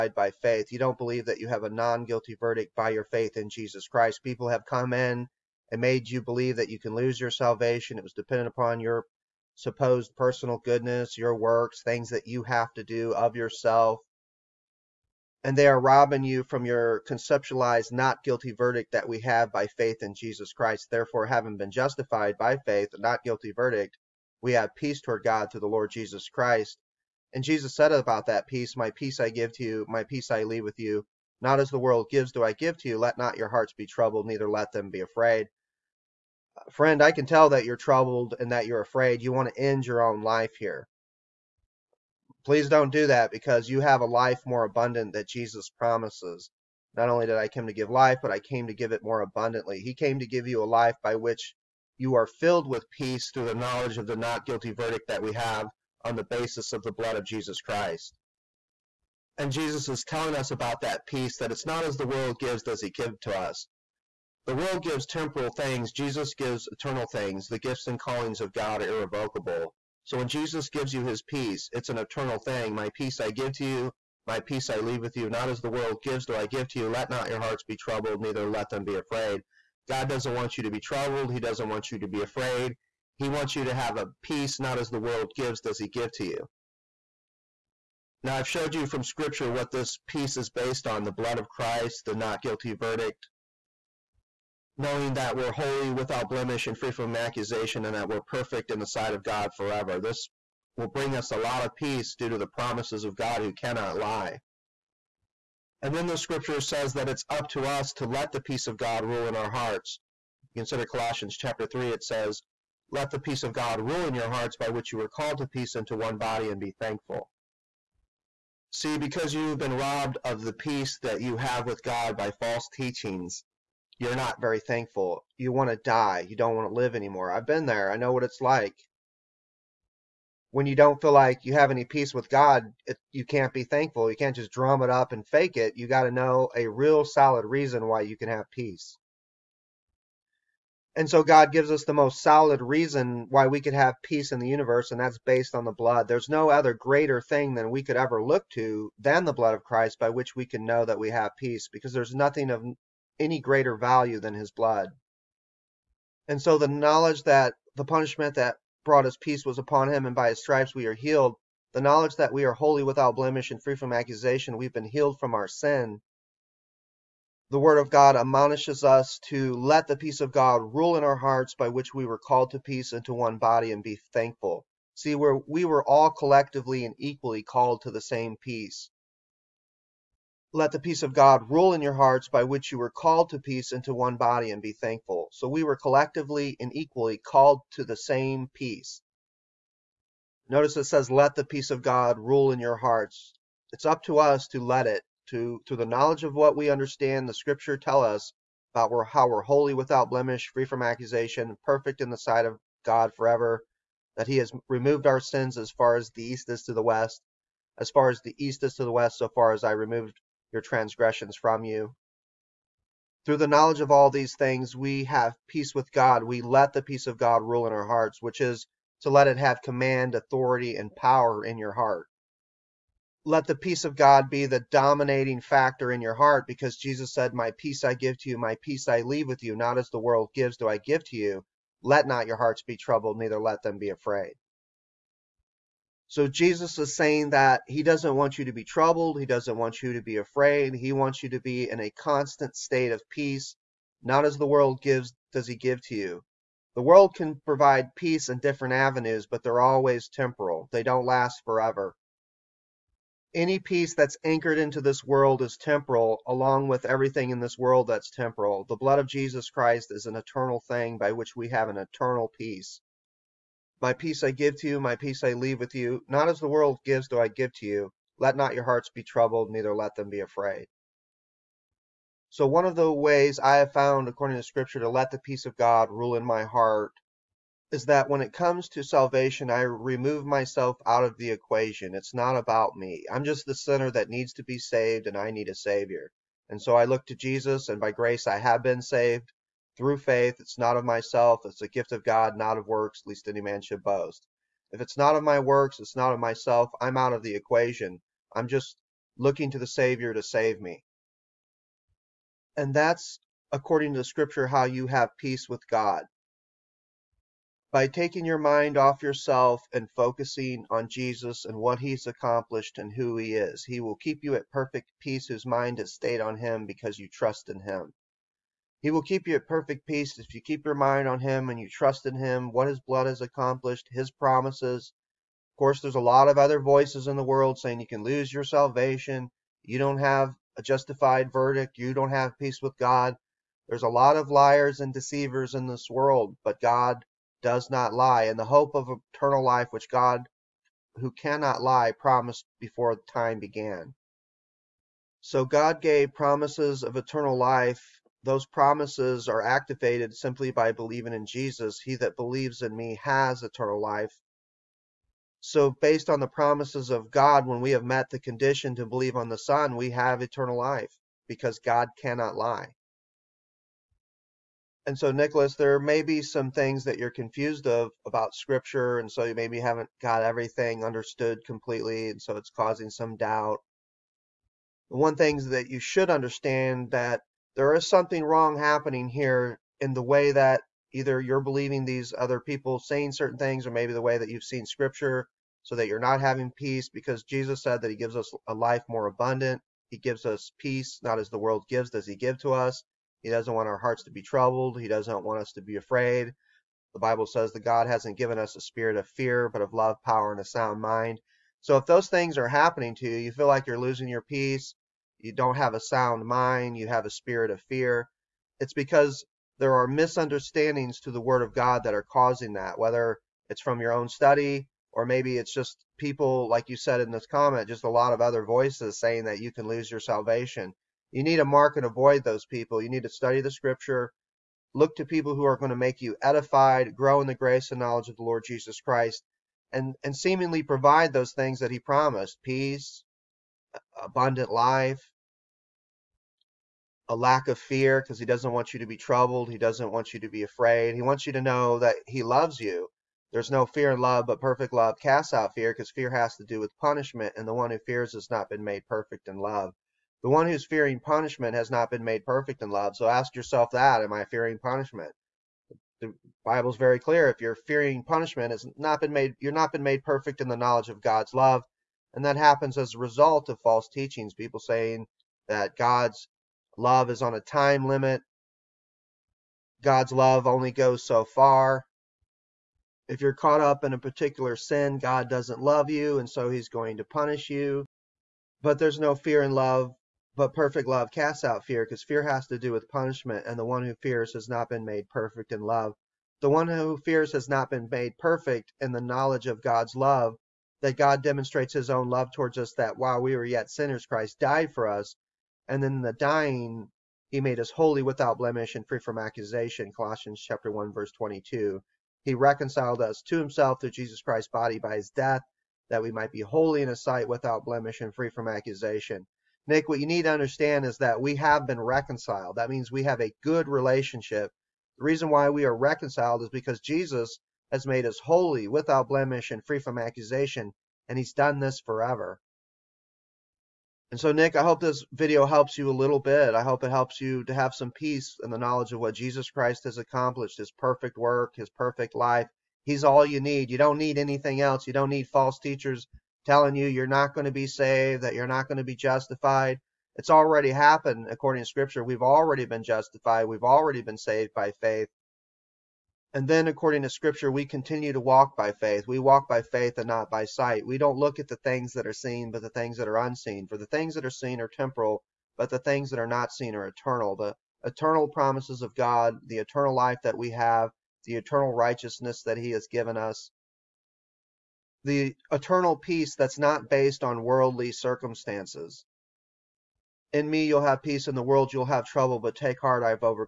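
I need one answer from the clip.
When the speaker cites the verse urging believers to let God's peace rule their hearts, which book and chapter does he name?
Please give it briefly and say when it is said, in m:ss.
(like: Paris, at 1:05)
Colossians chapter 3, at 1:50.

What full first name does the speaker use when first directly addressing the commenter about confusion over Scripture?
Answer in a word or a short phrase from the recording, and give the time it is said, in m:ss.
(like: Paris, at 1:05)
Nicholas, at 6:05.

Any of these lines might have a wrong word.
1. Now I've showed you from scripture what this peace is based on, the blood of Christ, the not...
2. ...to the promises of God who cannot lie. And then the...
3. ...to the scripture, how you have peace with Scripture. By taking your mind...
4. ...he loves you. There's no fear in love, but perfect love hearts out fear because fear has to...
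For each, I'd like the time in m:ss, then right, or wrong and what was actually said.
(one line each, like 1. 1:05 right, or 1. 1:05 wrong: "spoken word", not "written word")
1. 1:28 right
2. 1:42 right
3. 5:03 wrong: "God", not "Scripture"
4. 7:22 wrong: "casts", not "hearts".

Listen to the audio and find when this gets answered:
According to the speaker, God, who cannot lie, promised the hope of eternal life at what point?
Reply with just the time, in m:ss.
5:42.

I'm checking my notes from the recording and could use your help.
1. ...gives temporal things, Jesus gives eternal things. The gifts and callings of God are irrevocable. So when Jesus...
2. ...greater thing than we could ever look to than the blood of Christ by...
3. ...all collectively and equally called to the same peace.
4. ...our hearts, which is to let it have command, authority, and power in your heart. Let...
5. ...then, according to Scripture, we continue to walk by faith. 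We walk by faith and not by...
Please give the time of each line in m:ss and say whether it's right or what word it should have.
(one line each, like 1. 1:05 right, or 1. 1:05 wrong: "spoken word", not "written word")
1. 1:04 right
2. 2:26 right
3. 2:55 right
4. 3:37 right
5. 9:06 right.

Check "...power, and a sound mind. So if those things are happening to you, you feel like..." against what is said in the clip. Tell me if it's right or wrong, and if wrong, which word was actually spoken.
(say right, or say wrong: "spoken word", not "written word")
right.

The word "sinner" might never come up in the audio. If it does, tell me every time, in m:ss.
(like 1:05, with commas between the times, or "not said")
4:43, 8:13.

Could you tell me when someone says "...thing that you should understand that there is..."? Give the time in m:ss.
6:15.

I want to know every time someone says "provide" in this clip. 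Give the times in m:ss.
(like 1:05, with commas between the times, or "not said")
4:07, 7:10.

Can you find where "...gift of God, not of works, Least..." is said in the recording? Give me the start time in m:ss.
4:51.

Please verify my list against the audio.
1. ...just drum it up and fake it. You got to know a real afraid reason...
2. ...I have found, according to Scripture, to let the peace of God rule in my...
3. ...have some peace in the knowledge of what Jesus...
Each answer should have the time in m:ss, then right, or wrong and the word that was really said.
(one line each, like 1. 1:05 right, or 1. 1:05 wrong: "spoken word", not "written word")
1. 2:14 wrong: "solid", not "afraid"
2. 4:33 right
3. 8:47 right.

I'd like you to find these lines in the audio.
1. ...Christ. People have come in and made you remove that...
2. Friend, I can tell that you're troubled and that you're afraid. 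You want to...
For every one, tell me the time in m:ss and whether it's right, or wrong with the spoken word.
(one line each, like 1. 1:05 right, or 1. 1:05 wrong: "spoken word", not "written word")
1. 0:03 wrong: "believe", not "remove"
2. 0:36 right.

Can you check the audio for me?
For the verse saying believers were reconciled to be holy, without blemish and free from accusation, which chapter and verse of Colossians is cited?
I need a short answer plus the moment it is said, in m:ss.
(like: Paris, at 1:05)
chapter 1, verse 22, at 8:20.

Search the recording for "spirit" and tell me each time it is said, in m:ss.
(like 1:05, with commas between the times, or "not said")
6:38, 6:47.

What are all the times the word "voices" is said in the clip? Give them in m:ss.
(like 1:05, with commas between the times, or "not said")
5:26, 6:58.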